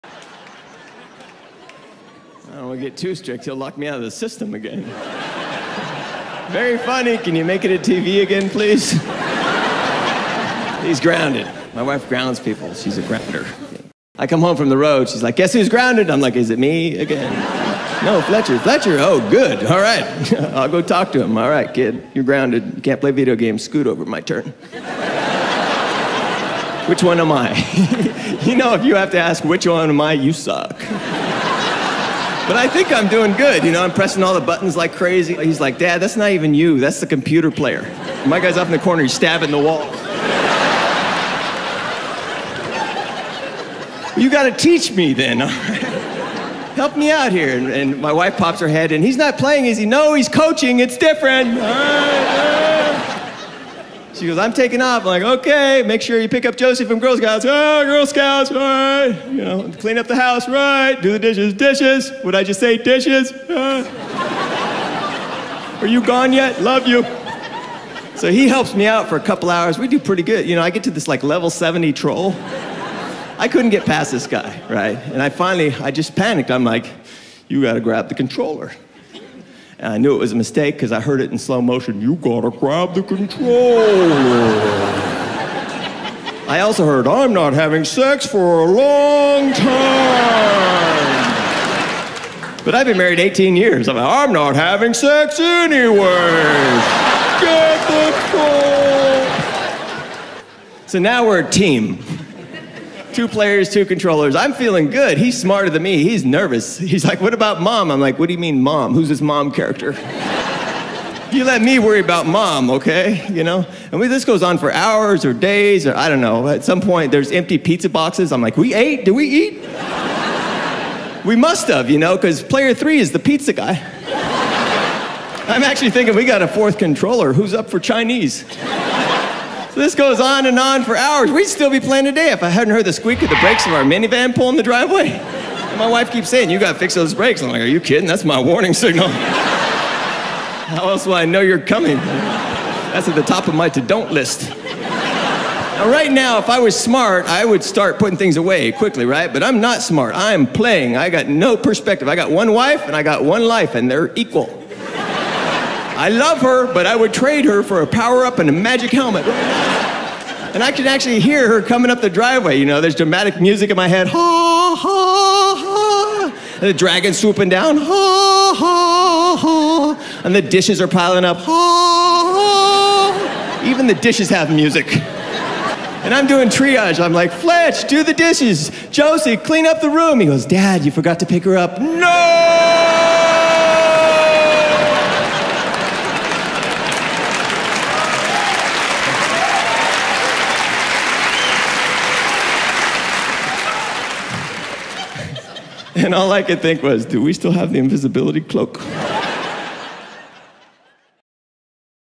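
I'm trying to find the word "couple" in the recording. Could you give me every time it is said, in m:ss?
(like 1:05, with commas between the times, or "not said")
1:09.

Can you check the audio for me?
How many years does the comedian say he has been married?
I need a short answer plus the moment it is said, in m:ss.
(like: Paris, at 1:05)
18, at 1:33.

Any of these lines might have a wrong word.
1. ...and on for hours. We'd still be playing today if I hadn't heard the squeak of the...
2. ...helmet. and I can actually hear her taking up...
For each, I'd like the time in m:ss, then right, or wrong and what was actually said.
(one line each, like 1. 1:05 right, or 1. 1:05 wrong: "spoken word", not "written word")
1. 2:10 right
2. 2:38 wrong: "coming", not "taking".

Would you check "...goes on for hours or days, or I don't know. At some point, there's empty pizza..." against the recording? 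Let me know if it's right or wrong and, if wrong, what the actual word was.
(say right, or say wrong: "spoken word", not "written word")
right.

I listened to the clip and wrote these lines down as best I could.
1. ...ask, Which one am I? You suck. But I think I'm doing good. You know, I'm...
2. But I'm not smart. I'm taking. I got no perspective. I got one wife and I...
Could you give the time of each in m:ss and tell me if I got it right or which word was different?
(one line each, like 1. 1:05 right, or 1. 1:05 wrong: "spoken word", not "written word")
1. 0:29 right
2. 2:29 wrong: "playing", not "taking".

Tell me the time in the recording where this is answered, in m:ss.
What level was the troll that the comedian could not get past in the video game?
1:11.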